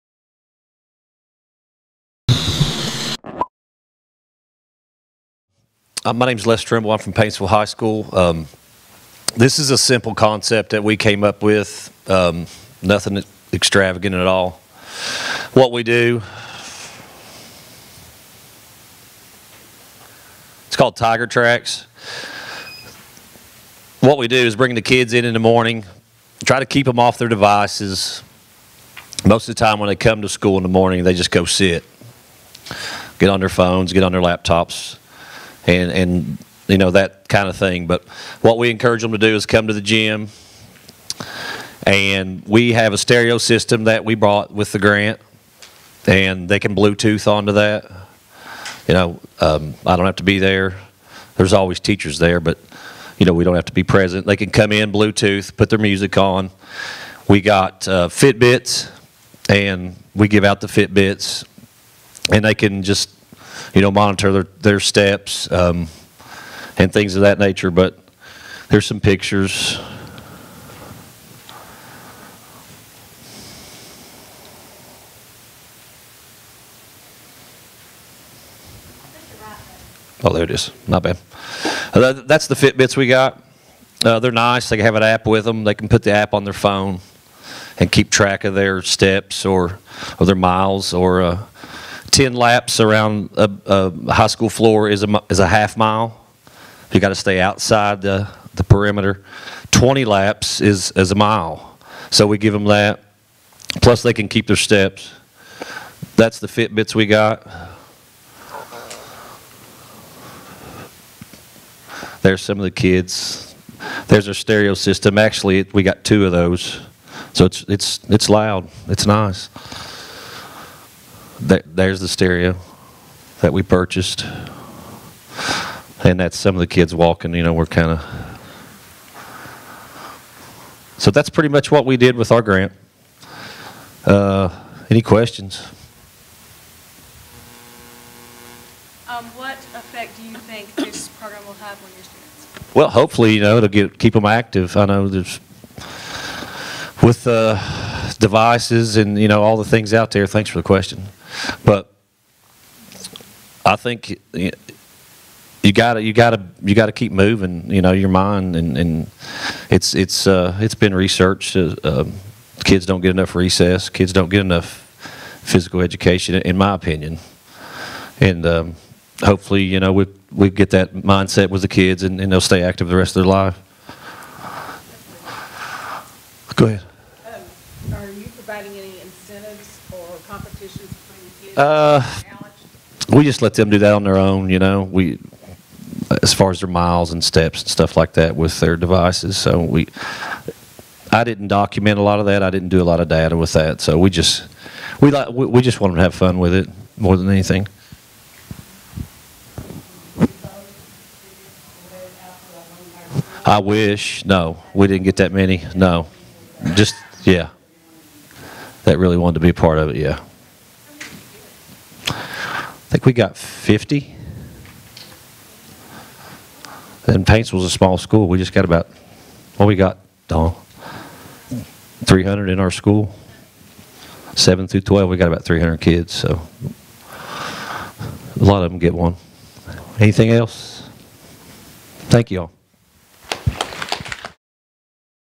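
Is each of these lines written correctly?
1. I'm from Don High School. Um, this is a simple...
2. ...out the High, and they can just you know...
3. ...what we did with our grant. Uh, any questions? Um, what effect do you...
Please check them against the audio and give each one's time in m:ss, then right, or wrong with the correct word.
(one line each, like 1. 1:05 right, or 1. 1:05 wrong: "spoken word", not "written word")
1. 0:06 wrong: "Paintsville", not "Don"
2. 1:00 wrong: "Fitbits", not "High"
3. 2:11 right.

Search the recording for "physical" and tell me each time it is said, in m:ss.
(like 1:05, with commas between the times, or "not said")
2:45.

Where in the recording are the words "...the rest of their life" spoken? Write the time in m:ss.
2:52.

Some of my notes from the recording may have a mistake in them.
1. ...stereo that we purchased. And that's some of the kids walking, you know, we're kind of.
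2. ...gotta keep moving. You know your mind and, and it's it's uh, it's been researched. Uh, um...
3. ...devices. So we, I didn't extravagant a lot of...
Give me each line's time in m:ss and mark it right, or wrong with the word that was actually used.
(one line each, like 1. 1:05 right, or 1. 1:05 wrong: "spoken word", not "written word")
1. 2:02 right
2. 2:36 right
3. 3:08 wrong: "document", not "extravagant".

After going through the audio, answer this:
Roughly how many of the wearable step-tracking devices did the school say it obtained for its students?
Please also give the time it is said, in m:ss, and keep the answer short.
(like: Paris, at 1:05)
50, at 3:33.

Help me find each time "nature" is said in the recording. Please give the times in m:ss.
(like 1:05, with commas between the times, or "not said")
1:07.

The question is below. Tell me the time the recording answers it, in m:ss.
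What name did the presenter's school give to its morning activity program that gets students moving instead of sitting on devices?
0:20.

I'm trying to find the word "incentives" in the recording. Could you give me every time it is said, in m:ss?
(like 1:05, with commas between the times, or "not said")
2:59.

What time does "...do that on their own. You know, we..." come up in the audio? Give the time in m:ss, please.
3:03.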